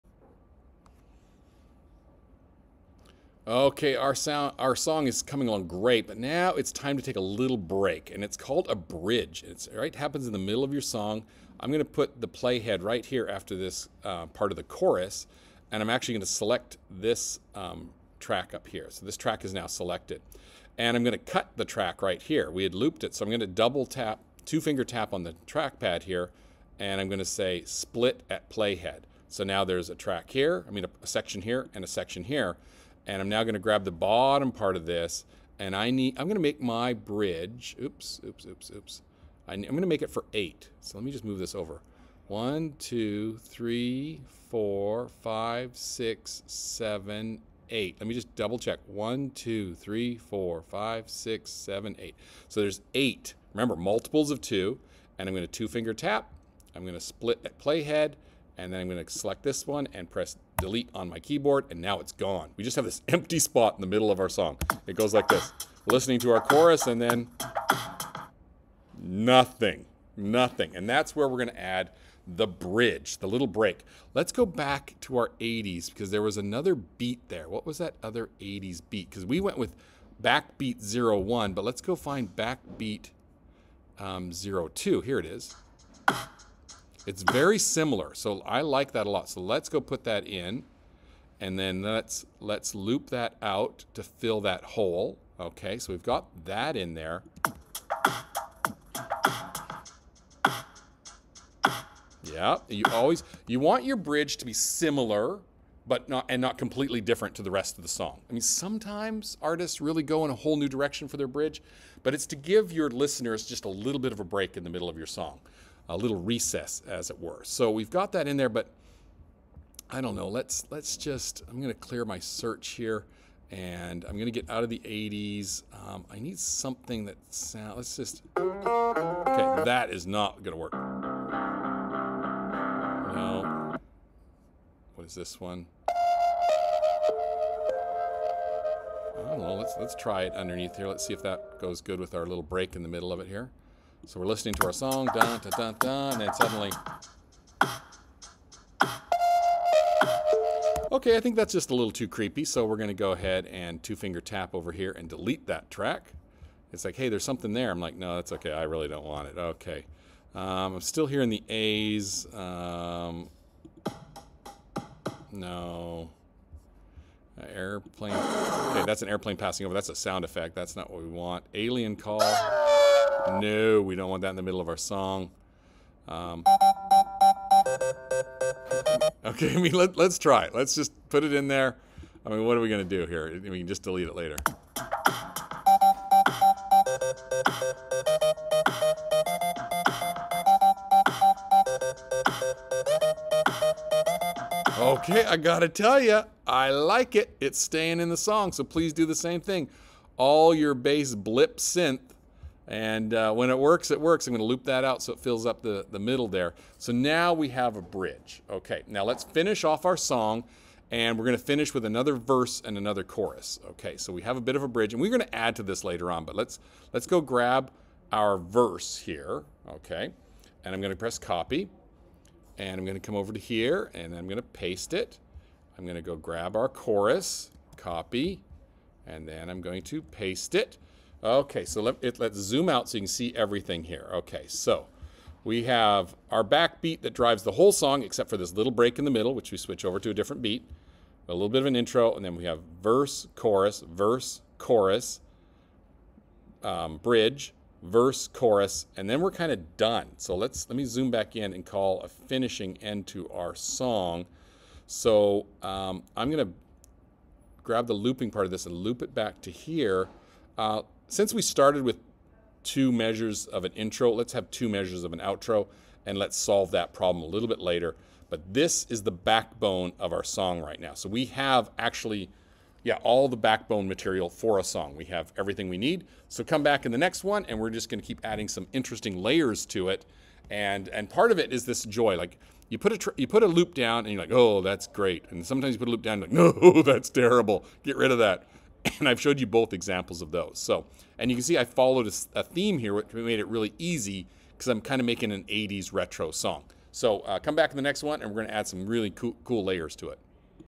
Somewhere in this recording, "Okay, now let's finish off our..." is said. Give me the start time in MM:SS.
03:28.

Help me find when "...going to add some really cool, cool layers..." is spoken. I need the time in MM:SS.
04:58.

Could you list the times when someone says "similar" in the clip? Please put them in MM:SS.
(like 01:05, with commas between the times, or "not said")
01:27, 01:44.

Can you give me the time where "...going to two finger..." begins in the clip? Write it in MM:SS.
00:55.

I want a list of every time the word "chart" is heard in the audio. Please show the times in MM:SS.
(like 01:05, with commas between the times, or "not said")
not said.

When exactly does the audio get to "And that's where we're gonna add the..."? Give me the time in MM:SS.
01:10.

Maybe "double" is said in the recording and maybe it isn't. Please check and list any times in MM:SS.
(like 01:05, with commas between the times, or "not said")
00:23, 00:48.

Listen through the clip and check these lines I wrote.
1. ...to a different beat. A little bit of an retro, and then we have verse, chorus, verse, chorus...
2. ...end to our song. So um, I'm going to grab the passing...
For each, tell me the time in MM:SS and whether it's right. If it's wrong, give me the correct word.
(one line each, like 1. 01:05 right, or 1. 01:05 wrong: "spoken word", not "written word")
1. 03:59 wrong: "intro", not "retro"
2. 04:12 wrong: "looping", not "passing".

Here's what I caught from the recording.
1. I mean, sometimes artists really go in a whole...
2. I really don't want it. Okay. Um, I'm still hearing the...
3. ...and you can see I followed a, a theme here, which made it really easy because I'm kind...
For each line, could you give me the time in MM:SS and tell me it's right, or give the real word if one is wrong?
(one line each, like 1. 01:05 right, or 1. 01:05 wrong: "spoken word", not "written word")
1. 01:48 right
2. 02:38 right
3. 04:51 right.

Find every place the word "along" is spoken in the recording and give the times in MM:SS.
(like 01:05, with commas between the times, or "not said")
00:05.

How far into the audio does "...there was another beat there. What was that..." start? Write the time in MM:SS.
01:16.